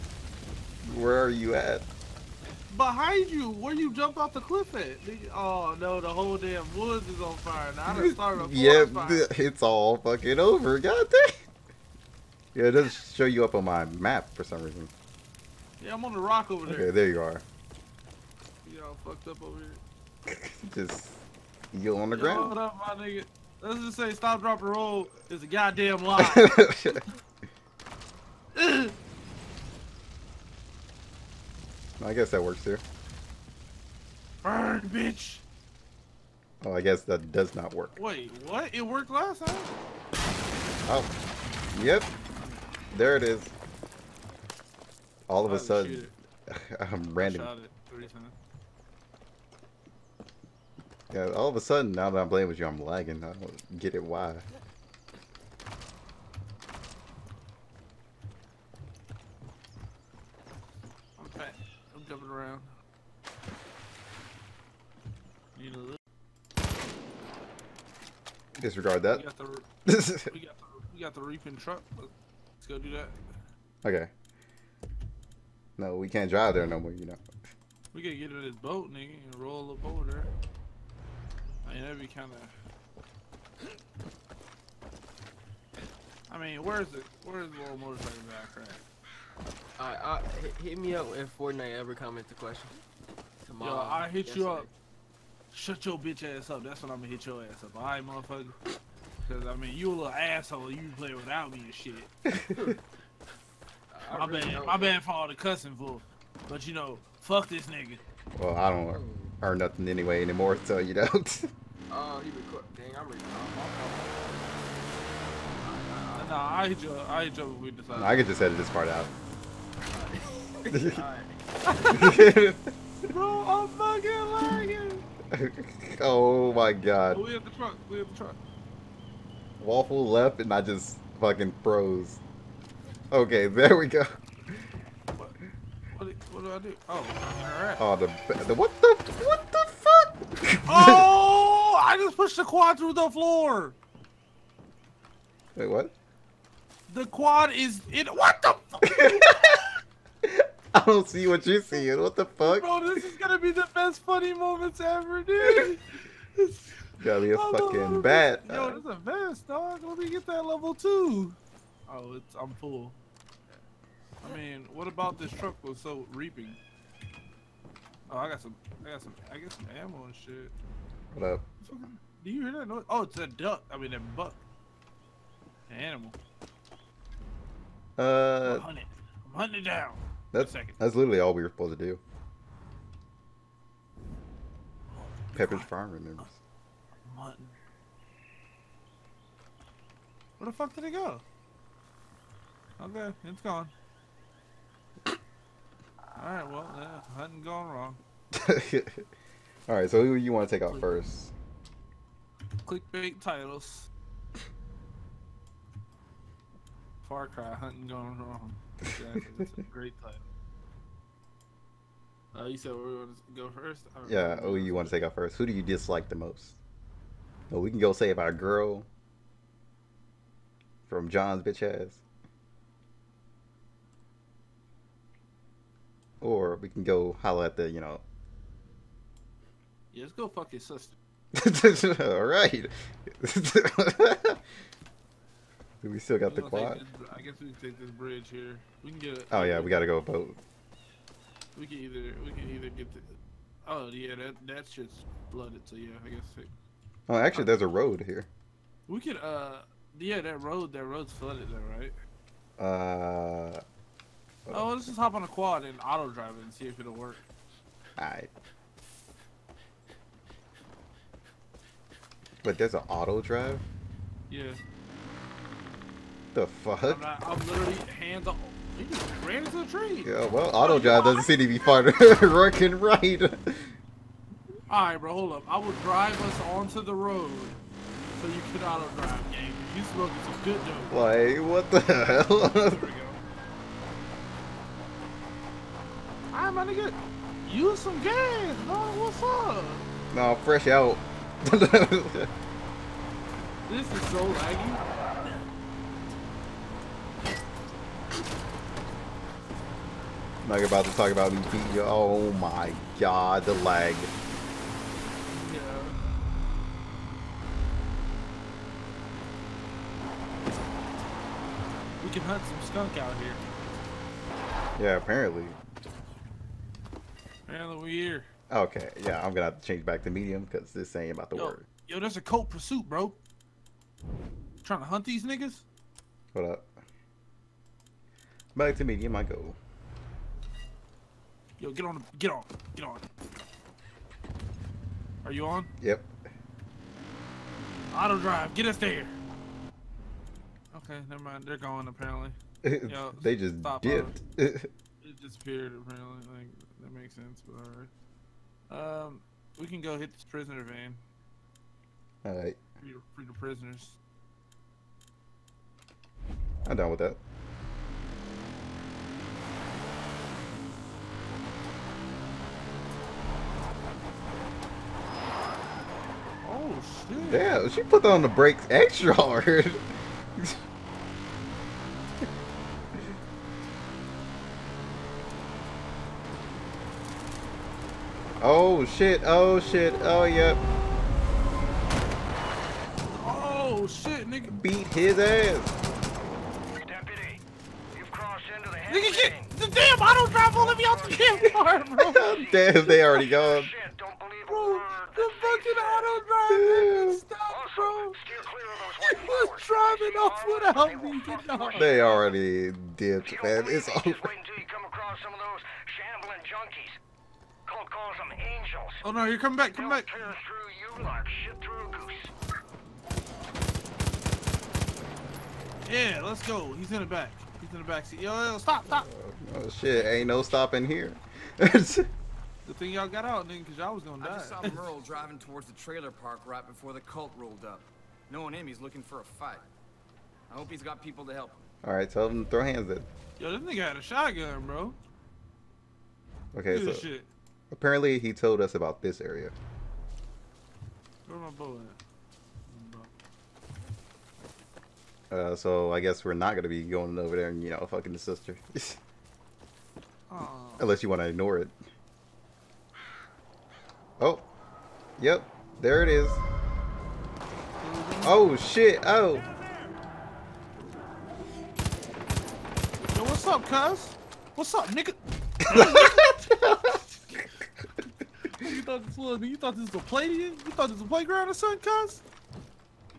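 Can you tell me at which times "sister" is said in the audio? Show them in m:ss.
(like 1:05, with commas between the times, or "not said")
3:50, 7:28.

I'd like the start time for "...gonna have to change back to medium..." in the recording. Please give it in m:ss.
5:19.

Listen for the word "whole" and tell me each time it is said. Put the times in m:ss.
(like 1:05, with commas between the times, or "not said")
0:06.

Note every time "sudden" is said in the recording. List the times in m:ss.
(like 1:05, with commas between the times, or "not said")
0:45, 0:51.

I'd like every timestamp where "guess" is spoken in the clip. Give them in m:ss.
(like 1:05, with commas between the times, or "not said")
0:32, 0:36, 3:57, 4:06, 7:25.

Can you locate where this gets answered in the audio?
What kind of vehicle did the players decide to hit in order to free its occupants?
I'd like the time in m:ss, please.
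5:50.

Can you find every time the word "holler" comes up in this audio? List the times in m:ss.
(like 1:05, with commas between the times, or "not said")
3:47.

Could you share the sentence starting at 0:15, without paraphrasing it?
Yeah, I'm on the rock over there.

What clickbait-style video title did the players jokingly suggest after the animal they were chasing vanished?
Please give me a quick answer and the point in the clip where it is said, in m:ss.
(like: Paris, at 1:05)
Far Cry, hunting gone wrong, at 3:27.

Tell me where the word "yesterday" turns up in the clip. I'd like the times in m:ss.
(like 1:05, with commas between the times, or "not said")
1:34.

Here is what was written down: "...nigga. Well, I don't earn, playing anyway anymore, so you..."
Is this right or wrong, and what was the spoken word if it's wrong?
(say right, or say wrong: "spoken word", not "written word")
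wrong: "nothing", not "playing".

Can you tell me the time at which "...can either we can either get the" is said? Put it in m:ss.
4:01.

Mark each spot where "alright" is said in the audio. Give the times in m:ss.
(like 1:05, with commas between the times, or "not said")
1:29, 2:17, 3:15, 3:19, 4:17, 4:34, 5:48.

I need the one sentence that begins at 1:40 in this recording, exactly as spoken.
You play without me and shit.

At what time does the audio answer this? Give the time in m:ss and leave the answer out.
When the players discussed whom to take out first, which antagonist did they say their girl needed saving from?
3:41.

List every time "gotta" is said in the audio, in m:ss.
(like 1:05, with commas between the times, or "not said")
2:37, 3:59.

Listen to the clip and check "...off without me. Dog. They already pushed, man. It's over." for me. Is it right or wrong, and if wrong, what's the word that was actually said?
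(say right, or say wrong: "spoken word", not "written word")
wrong: "dipped", not "pushed".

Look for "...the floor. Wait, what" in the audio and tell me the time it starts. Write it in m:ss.
2:22.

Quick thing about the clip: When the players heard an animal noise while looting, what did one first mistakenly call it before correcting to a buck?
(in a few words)
duck.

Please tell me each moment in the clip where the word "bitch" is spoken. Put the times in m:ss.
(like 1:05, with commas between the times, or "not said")
0:34, 1:35, 3:41.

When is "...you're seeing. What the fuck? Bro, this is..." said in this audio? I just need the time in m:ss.
2:31.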